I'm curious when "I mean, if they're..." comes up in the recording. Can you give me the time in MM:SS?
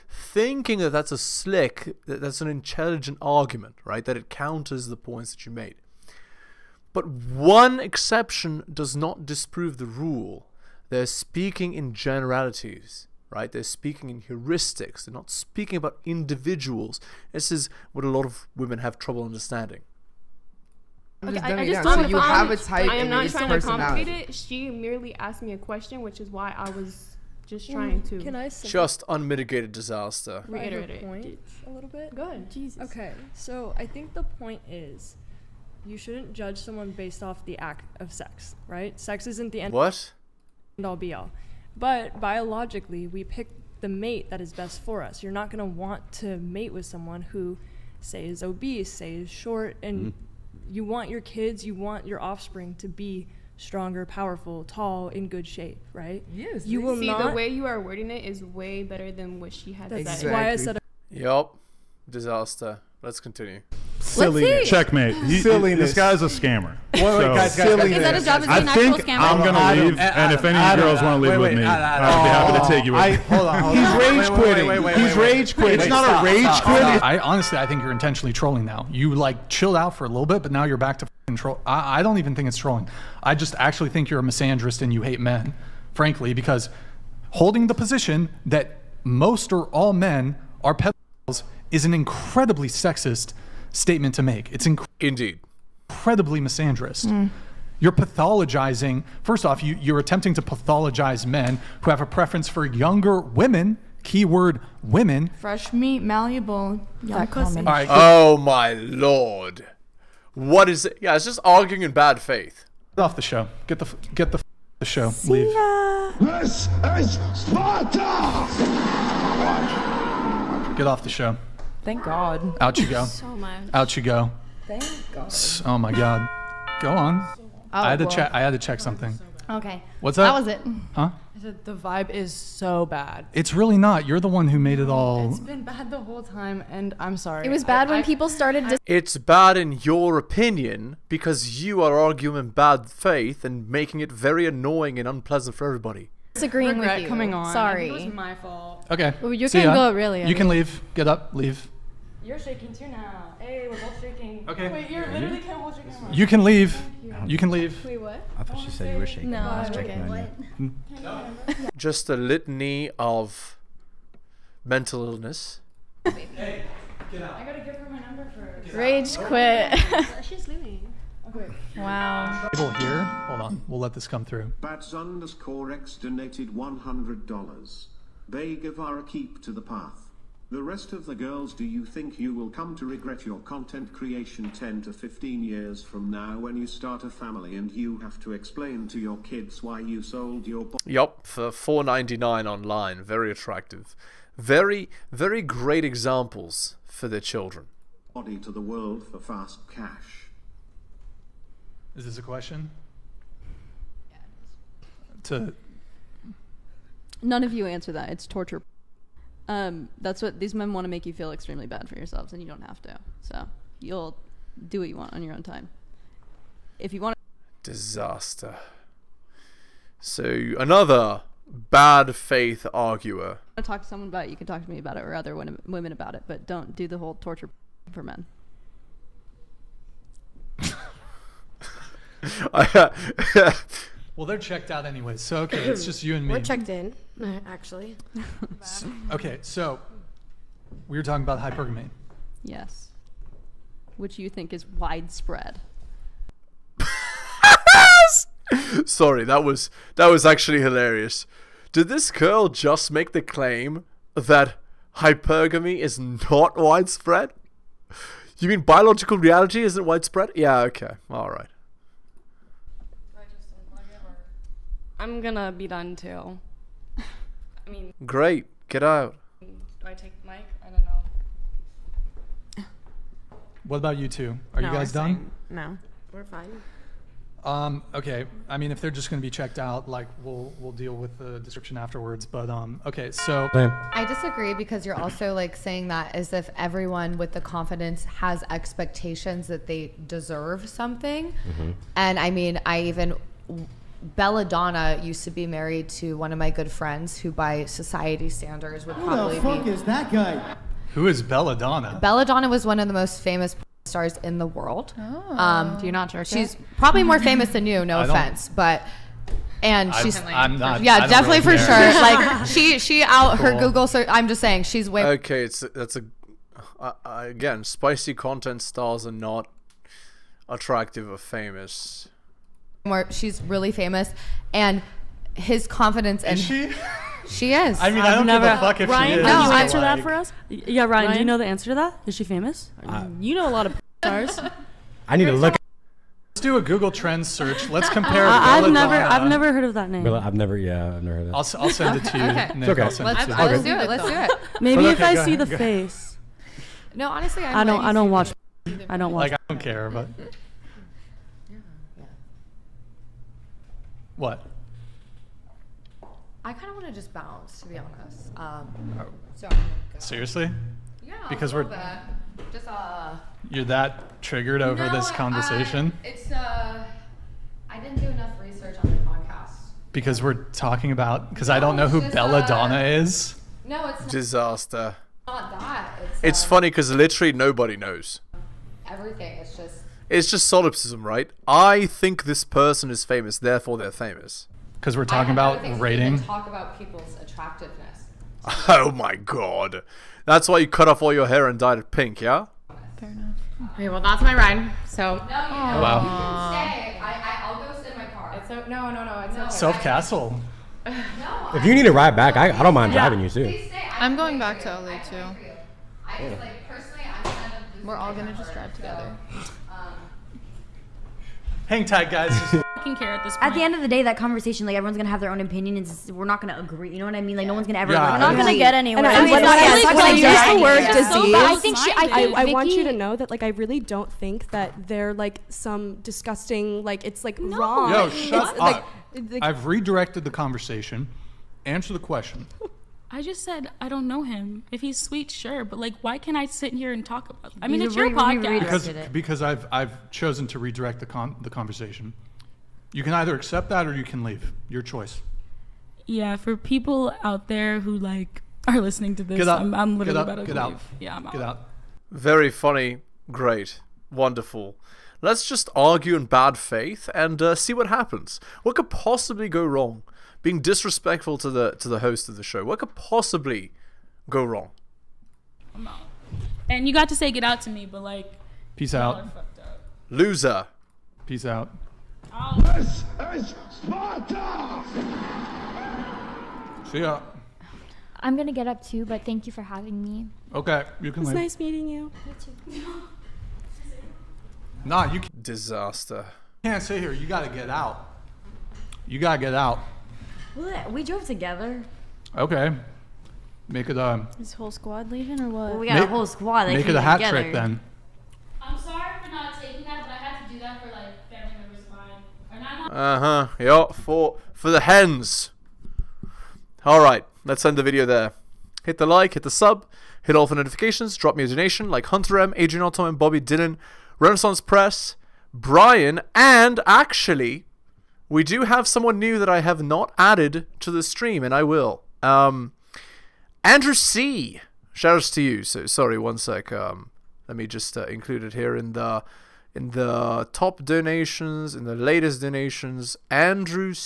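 04:38.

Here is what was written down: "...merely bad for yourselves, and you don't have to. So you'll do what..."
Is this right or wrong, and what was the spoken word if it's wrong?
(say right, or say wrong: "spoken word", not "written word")
wrong: "extremely", not "merely".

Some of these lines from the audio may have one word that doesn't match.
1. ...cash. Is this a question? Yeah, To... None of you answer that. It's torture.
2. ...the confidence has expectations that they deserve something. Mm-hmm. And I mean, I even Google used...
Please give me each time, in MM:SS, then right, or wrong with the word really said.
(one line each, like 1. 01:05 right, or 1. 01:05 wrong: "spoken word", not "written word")
1. 03:19 right
2. 04:47 wrong: "Belladonna", not "Google".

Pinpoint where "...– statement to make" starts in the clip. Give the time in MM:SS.
01:33.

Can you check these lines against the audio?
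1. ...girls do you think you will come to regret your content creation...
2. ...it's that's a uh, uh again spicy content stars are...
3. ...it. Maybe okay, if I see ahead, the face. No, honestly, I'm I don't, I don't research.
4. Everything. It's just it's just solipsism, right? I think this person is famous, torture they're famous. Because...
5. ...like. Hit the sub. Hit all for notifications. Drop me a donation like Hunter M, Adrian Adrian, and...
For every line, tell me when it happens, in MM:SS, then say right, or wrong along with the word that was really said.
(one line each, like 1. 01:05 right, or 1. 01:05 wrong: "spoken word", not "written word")
1. 03:01 right
2. 05:15 right
3. 05:44 wrong: "watch", not "research"
4. 06:18 wrong: "therefore", not "torture"
5. 08:29 wrong: "Otto", not "Adrian".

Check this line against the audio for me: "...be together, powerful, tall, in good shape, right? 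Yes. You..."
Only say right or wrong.
wrong.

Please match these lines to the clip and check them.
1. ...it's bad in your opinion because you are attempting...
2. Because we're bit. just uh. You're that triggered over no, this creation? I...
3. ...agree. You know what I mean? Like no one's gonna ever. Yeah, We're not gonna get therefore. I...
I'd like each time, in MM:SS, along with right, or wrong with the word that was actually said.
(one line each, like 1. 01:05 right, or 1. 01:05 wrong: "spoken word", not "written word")
1. 02:18 wrong: "arguing", not "attempting"
2. 06:01 wrong: "conversation", not "creation"
3. 06:56 wrong: "anywhere", not "therefore".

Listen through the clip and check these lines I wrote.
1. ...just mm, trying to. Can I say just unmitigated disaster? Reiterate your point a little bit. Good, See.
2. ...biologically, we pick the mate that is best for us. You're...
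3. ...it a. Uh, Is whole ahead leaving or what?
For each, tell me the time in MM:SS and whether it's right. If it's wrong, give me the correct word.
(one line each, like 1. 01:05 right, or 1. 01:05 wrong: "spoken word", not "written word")
1. 00:27 wrong: "Jesus", not "See"
2. 00:42 right
3. 08:13 wrong: "squad", not "ahead".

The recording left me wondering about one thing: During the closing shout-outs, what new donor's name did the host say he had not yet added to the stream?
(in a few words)
Andrew C.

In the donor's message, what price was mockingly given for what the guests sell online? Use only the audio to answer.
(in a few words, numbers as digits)
4.99.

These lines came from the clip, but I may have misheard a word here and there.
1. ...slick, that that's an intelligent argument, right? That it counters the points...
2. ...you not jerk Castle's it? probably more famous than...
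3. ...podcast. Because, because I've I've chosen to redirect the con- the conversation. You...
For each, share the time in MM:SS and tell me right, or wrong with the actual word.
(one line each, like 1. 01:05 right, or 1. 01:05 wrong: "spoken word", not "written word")
1. 00:01 right
2. 05:05 wrong: "She", not "Castle"
3. 07:18 right.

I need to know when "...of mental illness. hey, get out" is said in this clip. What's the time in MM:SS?
02:42.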